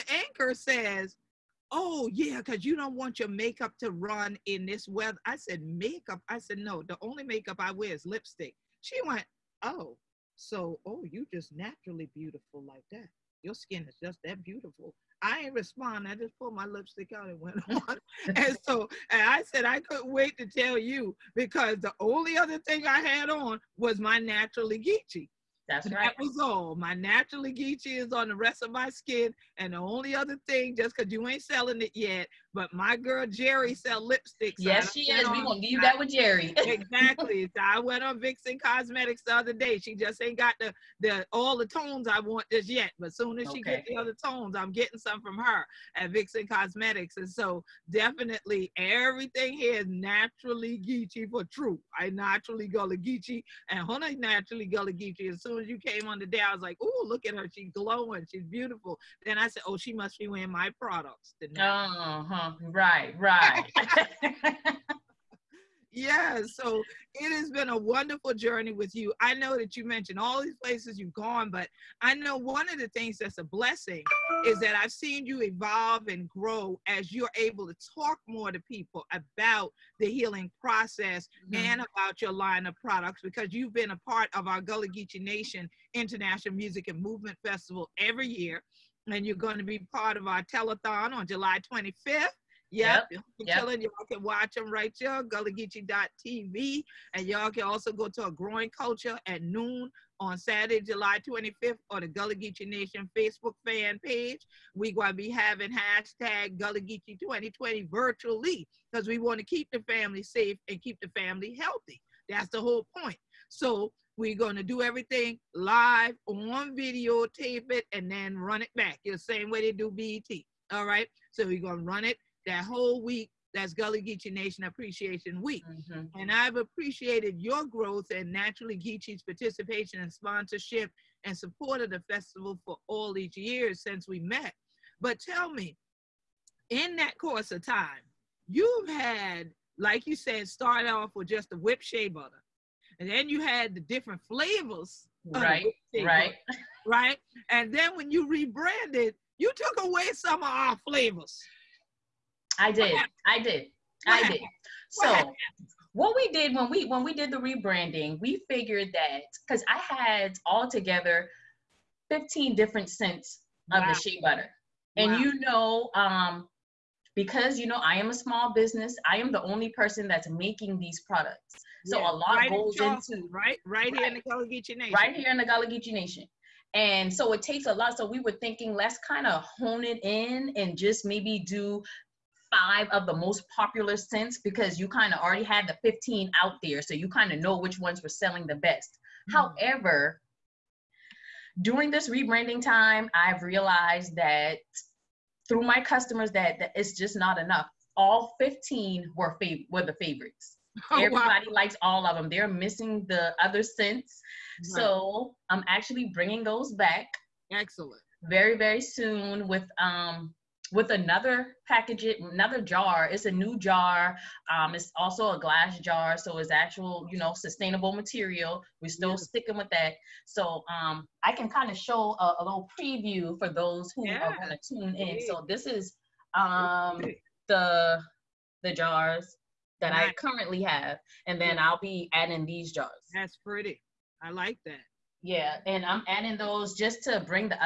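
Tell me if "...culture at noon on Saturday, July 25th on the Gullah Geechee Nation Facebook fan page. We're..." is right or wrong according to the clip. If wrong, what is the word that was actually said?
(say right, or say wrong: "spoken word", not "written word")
right.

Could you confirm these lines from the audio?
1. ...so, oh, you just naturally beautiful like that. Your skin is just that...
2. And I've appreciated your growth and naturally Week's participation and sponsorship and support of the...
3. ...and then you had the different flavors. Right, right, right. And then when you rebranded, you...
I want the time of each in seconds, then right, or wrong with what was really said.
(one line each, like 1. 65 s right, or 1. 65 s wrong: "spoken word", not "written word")
1. 10 s right
2. 126 s wrong: "Geechee", not "Week"
3. 142 s right.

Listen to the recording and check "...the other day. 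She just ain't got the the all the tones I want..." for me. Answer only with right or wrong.
right.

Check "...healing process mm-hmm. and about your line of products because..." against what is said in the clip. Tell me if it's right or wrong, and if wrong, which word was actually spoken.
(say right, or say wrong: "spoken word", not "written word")
right.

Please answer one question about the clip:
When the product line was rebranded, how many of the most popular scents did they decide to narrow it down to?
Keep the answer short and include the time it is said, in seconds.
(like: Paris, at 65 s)
5, at 182 s.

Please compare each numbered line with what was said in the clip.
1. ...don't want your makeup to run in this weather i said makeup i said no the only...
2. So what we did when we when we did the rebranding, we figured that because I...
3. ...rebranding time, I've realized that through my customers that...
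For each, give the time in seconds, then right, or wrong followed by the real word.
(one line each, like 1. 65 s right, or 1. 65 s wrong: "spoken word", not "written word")
1. 2 s right
2. 154 s right
3. 192 s right.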